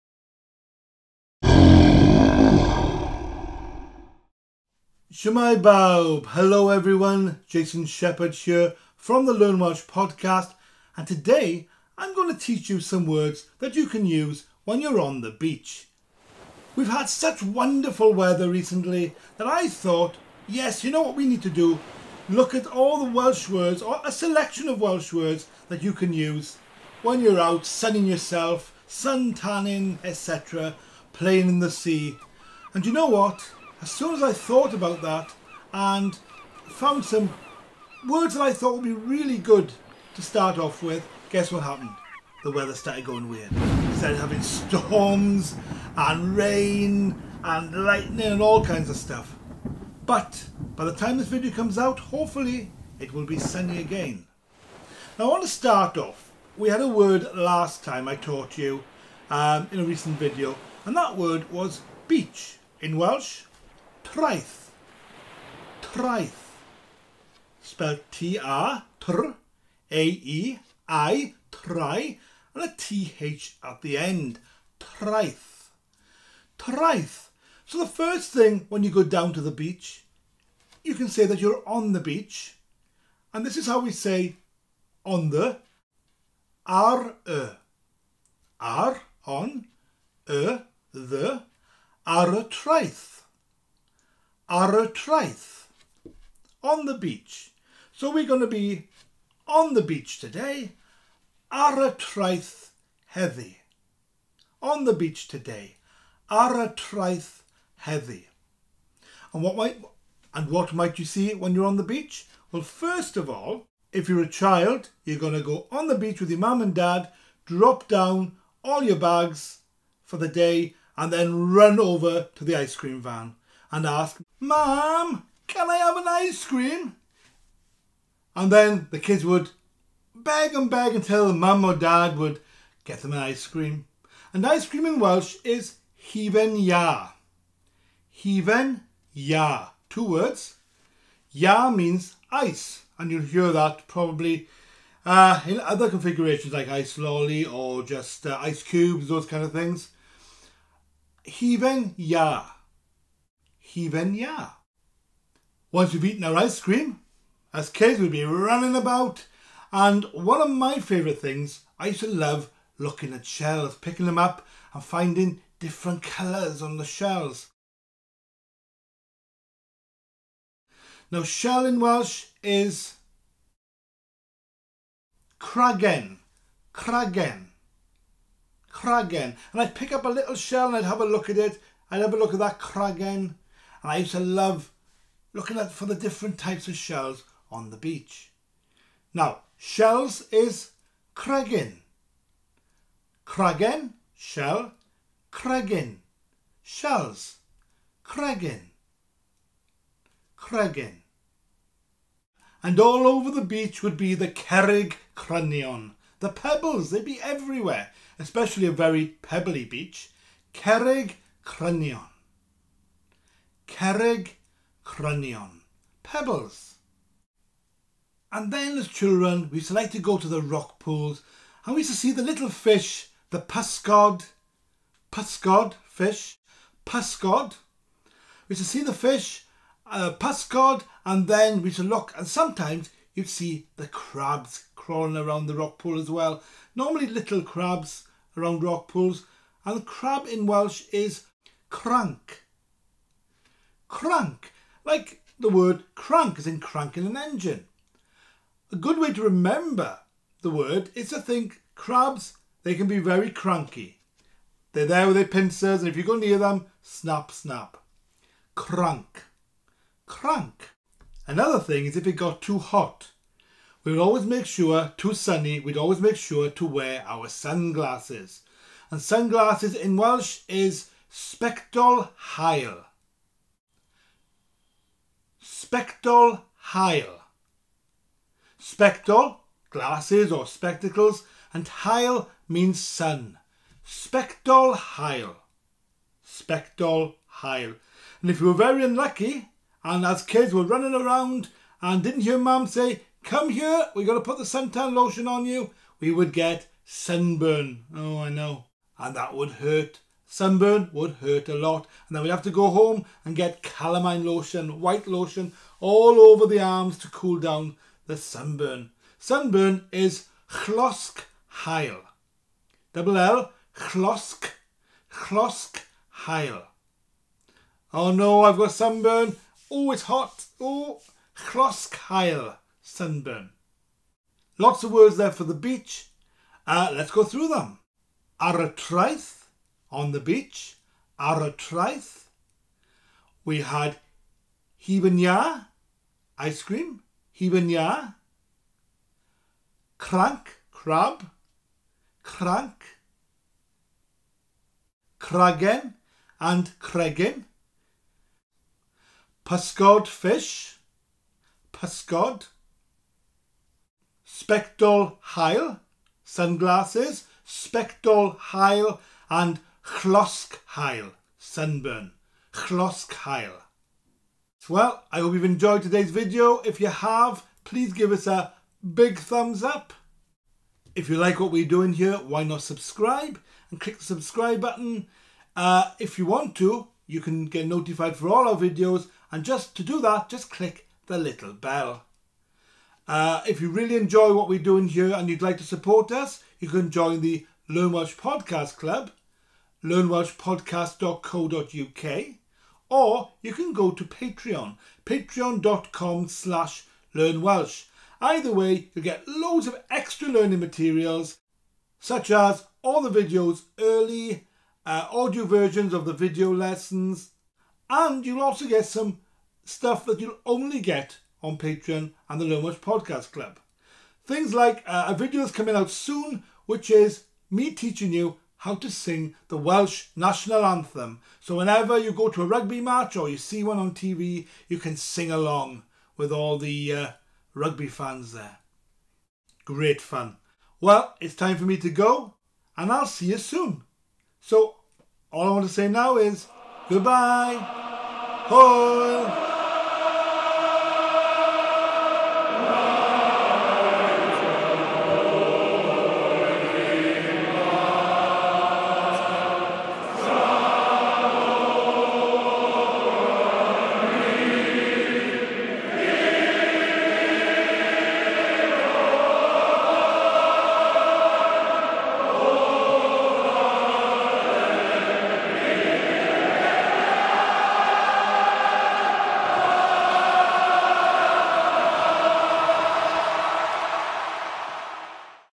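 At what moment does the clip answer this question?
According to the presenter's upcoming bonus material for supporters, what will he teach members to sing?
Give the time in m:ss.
6:59.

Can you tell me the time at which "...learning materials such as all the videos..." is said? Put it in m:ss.
6:40.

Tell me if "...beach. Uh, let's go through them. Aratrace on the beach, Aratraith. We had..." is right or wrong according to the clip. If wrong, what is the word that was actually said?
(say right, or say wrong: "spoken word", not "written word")
right.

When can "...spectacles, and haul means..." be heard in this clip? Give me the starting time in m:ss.
4:40.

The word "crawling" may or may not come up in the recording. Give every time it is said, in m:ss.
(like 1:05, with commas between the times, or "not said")
3:54.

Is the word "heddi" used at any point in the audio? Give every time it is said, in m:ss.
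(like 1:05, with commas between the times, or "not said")
1:43, 1:47.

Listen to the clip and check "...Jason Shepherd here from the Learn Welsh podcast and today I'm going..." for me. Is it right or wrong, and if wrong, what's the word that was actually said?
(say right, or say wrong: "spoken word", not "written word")
right.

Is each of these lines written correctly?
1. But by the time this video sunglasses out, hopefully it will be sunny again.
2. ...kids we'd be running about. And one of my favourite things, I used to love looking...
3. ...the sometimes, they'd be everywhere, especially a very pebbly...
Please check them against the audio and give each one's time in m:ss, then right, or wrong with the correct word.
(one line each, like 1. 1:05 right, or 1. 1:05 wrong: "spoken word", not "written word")
1. 0:50 wrong: "comes", not "sunglasses"
2. 2:37 right
3. 3:26 wrong: "pebbles", not "sometimes".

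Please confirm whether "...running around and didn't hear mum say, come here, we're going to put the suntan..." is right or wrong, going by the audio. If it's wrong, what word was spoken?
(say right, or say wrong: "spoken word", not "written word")
right.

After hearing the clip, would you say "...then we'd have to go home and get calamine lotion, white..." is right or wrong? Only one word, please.
right.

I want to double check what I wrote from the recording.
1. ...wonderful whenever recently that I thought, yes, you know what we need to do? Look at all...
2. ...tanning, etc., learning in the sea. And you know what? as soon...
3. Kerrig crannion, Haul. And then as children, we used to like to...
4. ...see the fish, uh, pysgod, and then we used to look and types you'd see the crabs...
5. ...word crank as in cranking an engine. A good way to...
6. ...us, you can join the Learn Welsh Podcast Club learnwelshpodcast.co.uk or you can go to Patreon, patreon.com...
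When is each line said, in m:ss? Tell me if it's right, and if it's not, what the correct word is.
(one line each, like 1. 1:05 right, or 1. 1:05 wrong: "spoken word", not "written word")
1. 0:17 wrong: "weather", not "whenever"
2. 0:29 wrong: "playing", not "learning"
3. 3:33 wrong: "Pebbles", not "Haul"
4. 3:48 wrong: "sometimes", not "types"
5. 4:05 right
6. 6:26 right.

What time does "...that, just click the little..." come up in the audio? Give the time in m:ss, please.
6:20.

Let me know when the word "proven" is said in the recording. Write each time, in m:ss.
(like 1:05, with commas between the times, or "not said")
not said.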